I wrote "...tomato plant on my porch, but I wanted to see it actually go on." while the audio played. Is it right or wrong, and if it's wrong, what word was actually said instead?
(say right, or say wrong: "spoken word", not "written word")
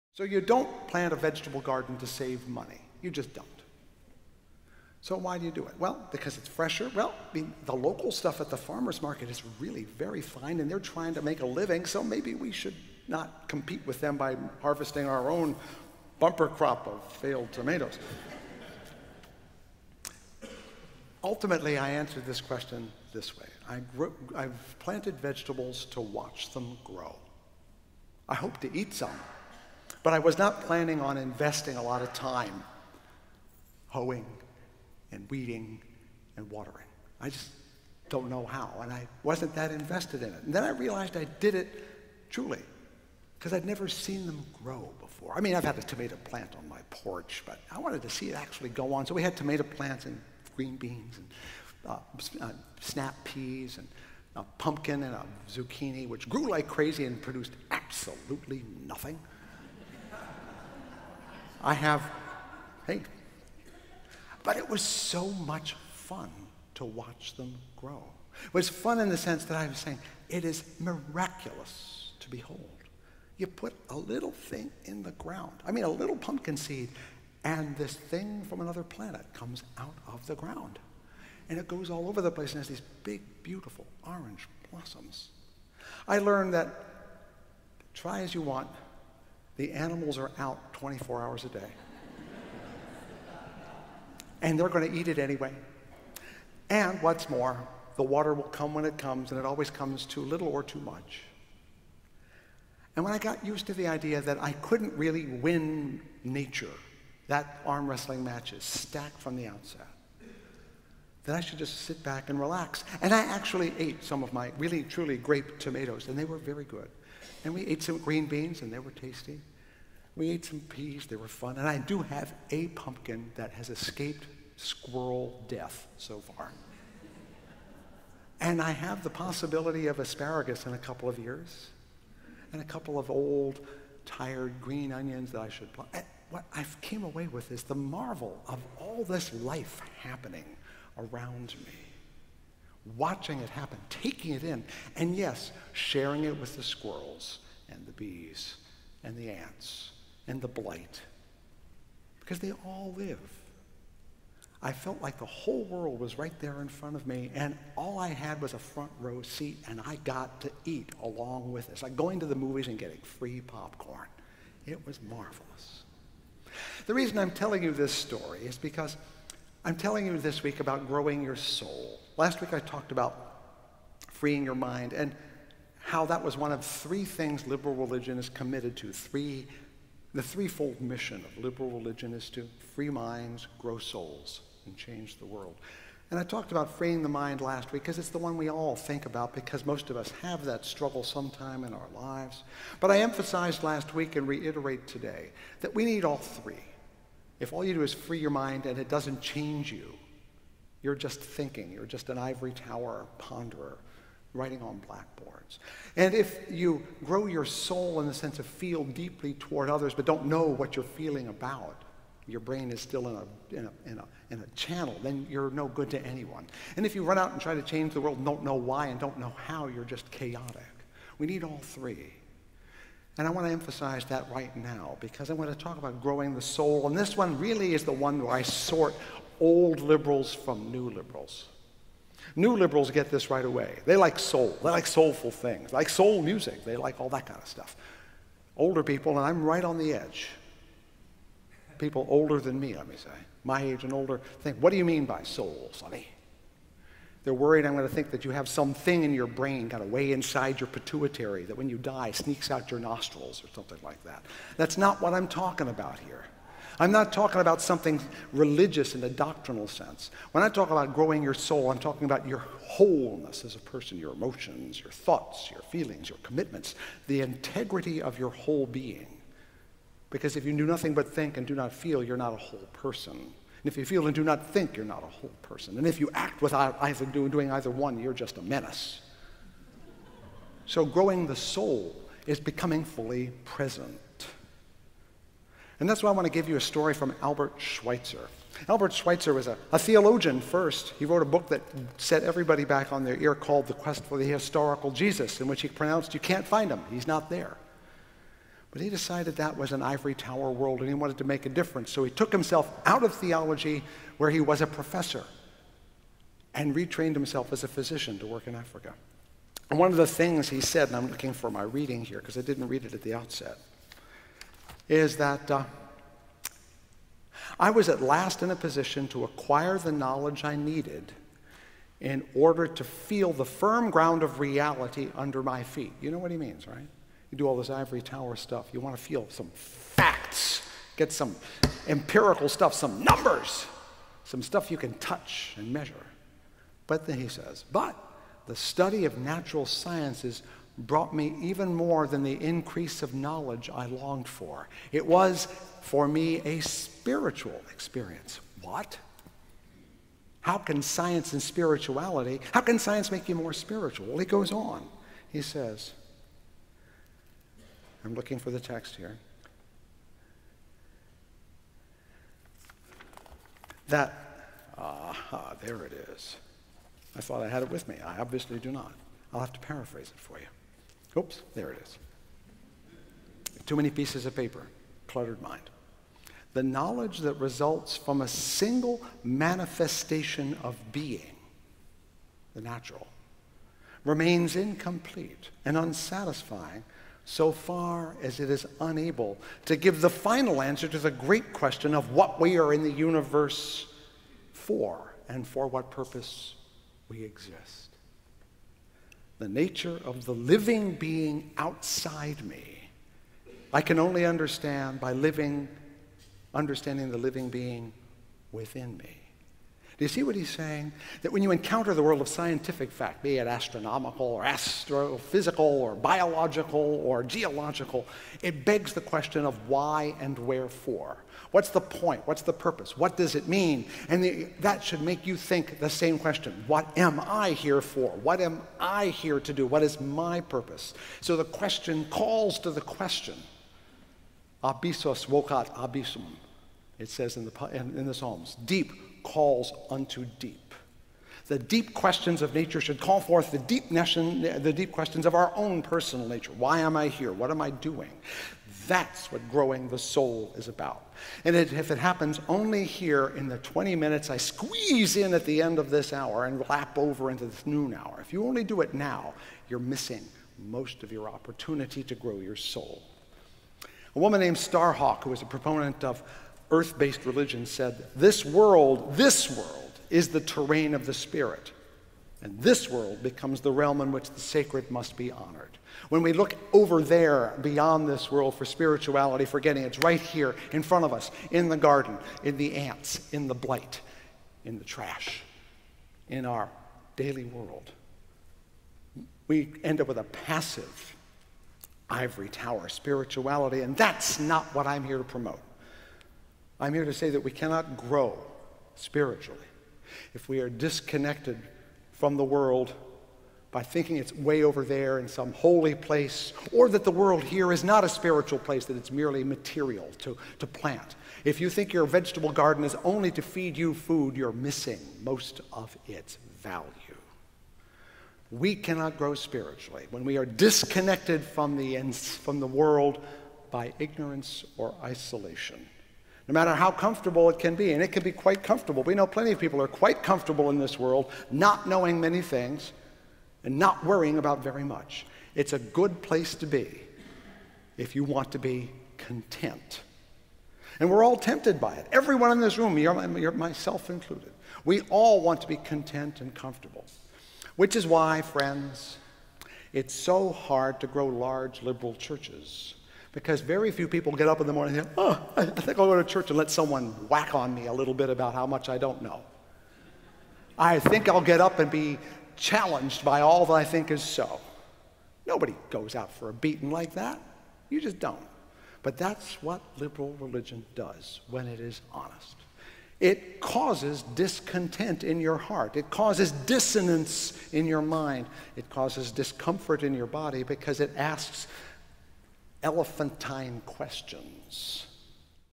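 right.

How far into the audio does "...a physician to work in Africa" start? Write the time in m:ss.
5:07.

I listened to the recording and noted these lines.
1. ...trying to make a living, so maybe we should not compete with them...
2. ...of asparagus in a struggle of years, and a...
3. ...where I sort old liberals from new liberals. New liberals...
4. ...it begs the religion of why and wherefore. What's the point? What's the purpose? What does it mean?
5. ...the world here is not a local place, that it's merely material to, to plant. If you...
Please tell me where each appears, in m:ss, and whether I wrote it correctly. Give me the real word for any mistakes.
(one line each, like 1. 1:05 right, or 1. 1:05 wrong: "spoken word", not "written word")
1. 0:10 right
2. 2:09 wrong: "couple", not "struggle"
3. 3:48 right
4. 6:58 wrong: "question", not "religion"
5. 8:27 wrong: "spiritual", not "local".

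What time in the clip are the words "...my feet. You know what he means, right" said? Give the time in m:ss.
5:25.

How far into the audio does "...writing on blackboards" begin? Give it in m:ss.
3:24.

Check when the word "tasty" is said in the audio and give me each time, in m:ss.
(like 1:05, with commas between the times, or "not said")
1:58.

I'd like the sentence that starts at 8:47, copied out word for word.
And it can be quite comfortable.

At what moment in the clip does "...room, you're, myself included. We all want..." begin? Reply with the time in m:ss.
9:02.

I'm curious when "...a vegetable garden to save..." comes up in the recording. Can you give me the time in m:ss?
0:01.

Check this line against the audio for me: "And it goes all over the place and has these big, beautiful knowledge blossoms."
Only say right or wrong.
wrong.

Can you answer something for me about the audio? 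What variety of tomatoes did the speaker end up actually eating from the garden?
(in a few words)
grape tomatoes.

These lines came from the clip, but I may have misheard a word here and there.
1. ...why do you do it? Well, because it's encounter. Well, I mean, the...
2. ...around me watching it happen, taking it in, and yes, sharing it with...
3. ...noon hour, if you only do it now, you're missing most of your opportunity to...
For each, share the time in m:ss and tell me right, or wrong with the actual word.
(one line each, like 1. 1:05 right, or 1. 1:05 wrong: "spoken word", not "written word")
1. 0:05 wrong: "fresher", not "encounter"
2. 2:20 right
3. 7:37 right.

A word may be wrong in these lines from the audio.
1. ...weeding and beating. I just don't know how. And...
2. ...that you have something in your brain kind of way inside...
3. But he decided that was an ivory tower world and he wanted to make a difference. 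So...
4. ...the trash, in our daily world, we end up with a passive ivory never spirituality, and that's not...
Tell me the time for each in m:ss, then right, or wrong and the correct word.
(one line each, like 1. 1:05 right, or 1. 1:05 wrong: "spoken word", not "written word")
1. 0:35 wrong: "watering", not "beating"
2. 4:08 right
3. 4:58 right
4. 8:04 wrong: "tower", not "never".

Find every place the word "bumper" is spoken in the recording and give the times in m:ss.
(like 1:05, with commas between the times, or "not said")
0:16.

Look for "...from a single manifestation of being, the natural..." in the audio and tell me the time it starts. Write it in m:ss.
6:17.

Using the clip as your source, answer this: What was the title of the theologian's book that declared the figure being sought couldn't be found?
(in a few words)
The Quest for the Historical Jesus.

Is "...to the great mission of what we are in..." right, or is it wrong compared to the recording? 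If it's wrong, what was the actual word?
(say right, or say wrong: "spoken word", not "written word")
wrong: "question", not "mission".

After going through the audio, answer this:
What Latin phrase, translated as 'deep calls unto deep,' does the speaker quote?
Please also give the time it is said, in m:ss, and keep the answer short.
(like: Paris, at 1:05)
Abyssus vocat abyssum, at 7:14.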